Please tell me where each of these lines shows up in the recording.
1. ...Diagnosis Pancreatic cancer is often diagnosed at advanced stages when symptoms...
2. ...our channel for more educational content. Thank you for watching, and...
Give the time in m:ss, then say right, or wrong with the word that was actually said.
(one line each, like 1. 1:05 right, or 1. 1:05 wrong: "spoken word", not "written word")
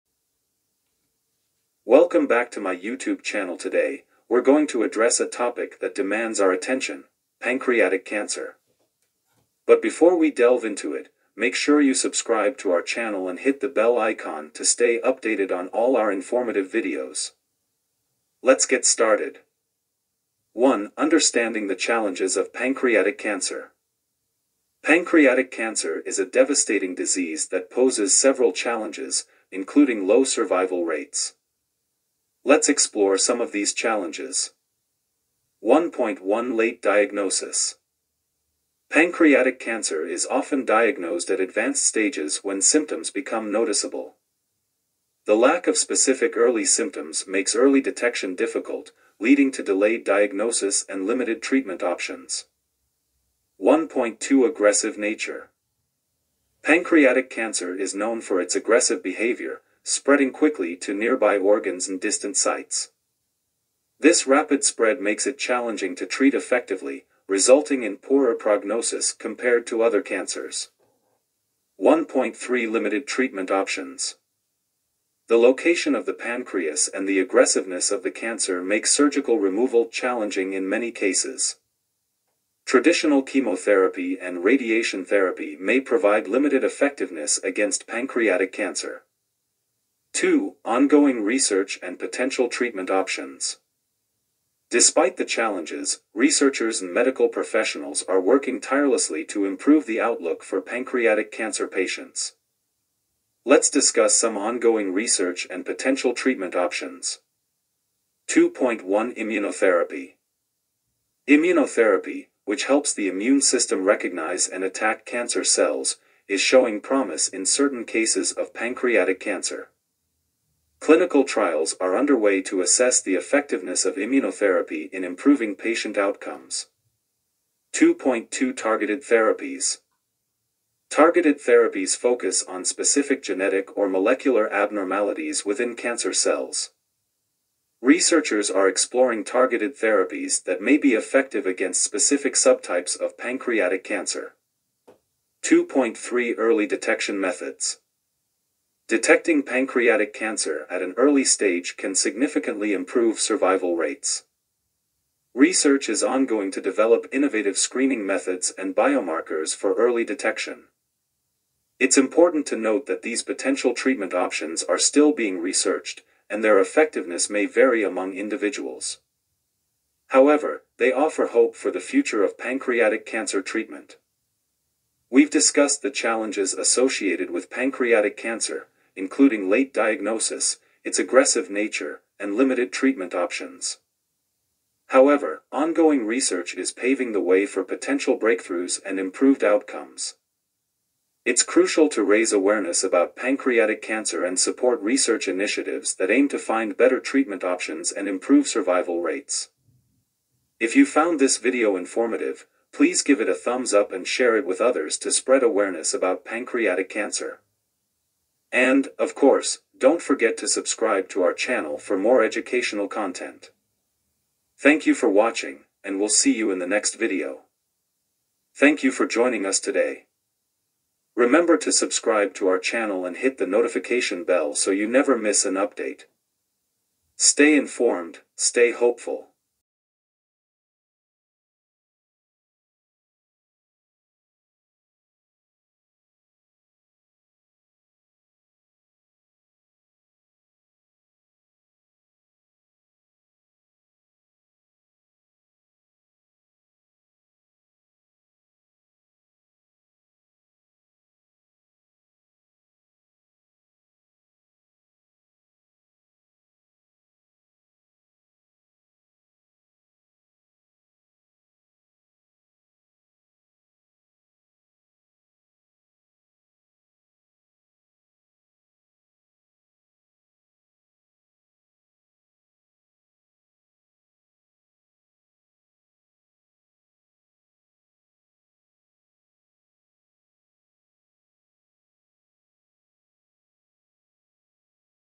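1. 0:36 right
2. 3:31 right.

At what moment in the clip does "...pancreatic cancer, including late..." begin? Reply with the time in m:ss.
2:57.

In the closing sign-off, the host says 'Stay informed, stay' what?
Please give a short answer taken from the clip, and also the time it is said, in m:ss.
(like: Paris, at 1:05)
hopeful, at 3:48.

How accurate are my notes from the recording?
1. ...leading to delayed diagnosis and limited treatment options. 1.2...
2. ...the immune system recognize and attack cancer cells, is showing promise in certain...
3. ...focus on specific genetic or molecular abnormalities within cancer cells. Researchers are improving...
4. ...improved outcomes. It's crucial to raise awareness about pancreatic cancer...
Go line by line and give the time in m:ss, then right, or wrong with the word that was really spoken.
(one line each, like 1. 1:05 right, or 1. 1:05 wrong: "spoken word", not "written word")
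1. 0:49 right
2. 1:52 right
3. 2:11 wrong: "exploring", not "improving"
4. 3:08 right.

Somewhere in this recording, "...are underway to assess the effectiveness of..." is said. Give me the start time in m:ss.
2:01.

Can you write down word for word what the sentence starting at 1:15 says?
The location of the pancreas and the aggressiveness of the cancer make surgical removal challenging in many cases.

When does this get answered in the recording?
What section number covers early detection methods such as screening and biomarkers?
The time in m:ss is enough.
2:25.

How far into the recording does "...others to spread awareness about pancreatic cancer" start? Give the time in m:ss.
3:24.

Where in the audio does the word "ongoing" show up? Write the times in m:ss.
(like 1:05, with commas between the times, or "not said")
1:30, 1:44, 2:36, 3:05.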